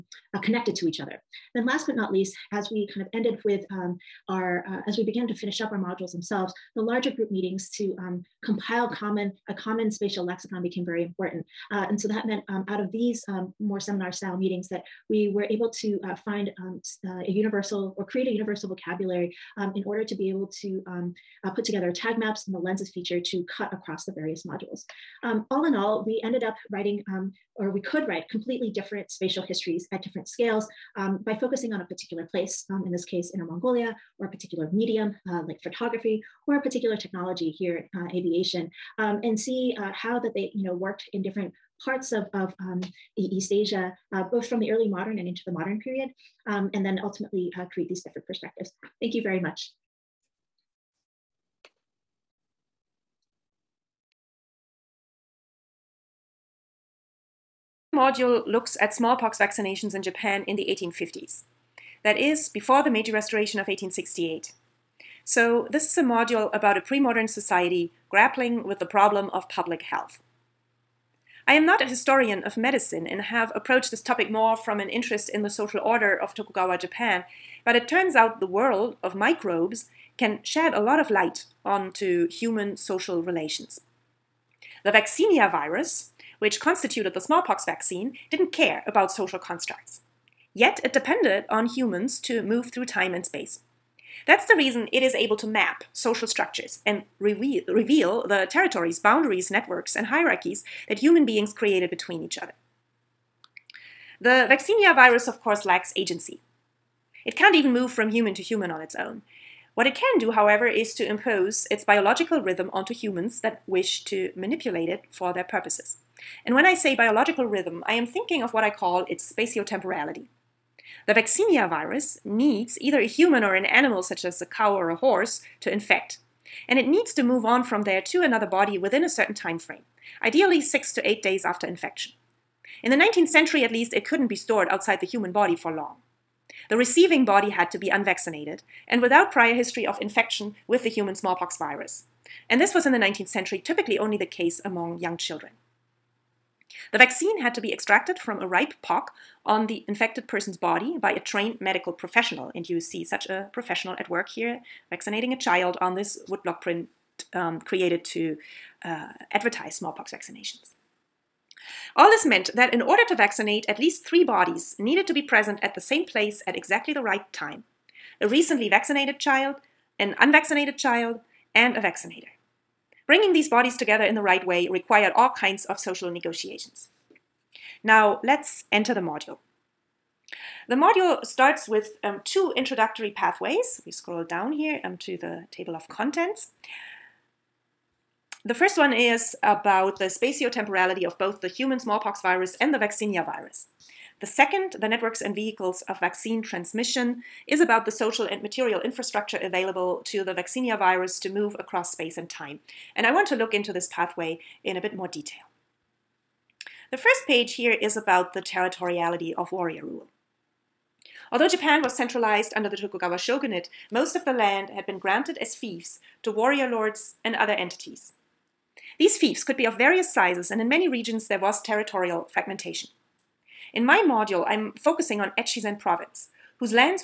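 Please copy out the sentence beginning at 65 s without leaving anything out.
So this is a module about a pre-modern society grappling with the problem of public health.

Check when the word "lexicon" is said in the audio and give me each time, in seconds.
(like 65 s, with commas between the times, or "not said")
10 s.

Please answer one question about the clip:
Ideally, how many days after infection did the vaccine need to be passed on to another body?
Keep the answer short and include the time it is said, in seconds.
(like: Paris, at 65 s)
6 to 8 days, at 130 s.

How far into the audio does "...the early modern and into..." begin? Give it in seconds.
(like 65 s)
44 s.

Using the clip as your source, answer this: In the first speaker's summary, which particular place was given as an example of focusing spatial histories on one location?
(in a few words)
Inner Mongolia.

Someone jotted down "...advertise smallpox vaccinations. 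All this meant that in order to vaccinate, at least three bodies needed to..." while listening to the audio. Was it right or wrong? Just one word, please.
right.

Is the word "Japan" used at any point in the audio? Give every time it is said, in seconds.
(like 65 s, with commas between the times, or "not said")
60 s, 76 s, 211 s.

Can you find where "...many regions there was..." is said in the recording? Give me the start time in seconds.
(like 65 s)
220 s.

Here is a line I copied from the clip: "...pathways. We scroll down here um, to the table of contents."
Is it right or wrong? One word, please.
right.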